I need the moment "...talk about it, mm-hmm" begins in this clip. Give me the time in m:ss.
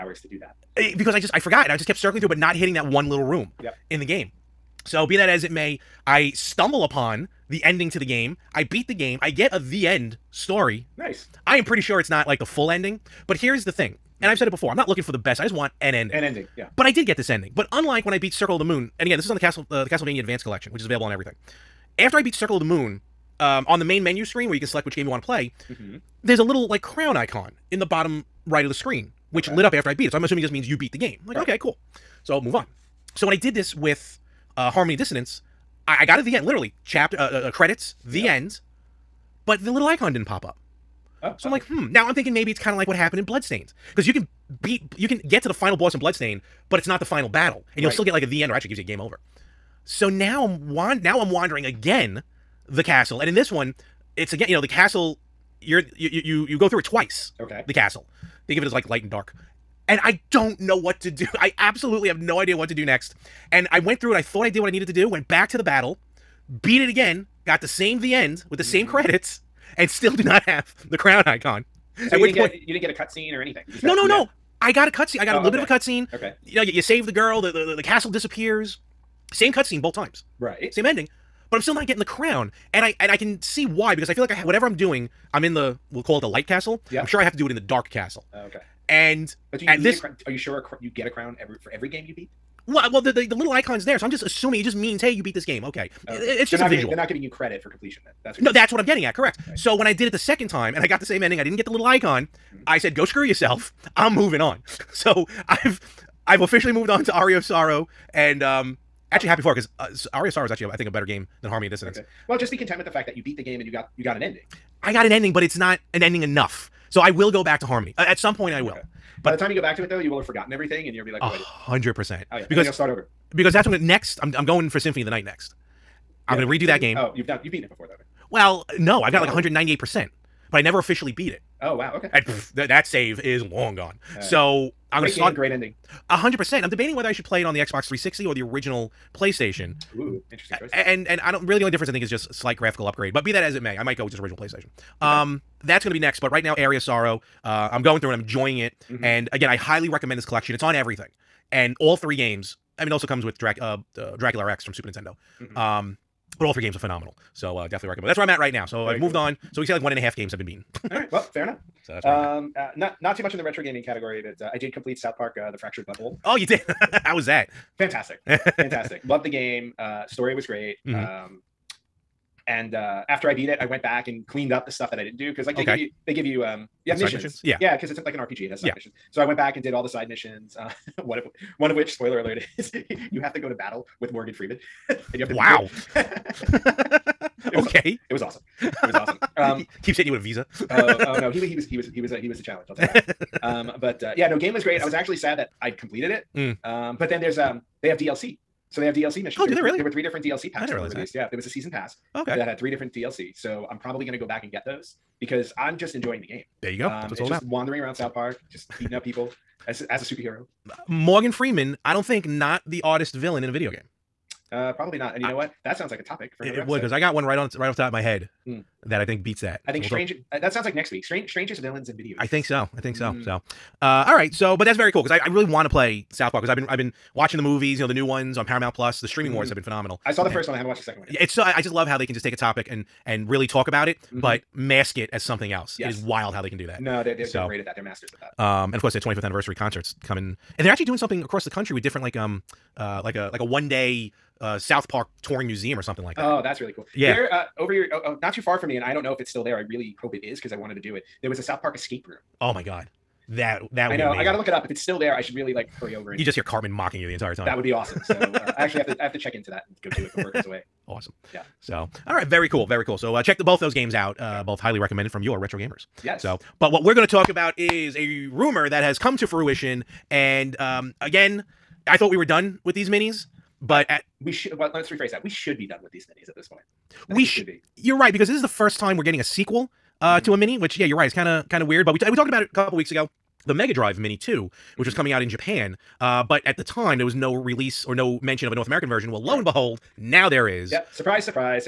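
3:53.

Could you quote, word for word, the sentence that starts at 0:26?
there's a little like crown icon in the bottom right of the screen, which okay.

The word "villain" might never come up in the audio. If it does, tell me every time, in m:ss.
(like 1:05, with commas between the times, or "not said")
3:33, 3:41.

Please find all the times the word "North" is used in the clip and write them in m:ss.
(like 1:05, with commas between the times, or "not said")
4:48.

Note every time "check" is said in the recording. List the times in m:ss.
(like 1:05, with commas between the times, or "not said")
4:19, 4:23.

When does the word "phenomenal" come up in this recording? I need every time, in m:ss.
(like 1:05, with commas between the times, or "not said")
2:36, 3:49.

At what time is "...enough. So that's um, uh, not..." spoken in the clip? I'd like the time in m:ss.
2:41.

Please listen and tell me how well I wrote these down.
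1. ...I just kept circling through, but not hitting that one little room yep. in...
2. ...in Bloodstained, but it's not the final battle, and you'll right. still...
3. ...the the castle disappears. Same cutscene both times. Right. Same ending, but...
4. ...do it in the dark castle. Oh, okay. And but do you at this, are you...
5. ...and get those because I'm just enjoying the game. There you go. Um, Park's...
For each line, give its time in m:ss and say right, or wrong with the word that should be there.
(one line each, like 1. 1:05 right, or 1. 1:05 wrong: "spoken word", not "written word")
1. 0:01 right
2. 0:45 right
3. 1:17 right
4. 1:27 right
5. 3:24 wrong: "That", not "Park".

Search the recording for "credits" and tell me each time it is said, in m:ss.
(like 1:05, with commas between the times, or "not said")
0:37, 1:08, 1:37.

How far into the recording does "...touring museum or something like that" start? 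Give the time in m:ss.
4:05.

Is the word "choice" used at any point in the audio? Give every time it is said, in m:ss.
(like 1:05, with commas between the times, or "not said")
2:20.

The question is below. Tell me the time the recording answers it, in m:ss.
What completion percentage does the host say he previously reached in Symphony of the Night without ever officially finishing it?
2:09.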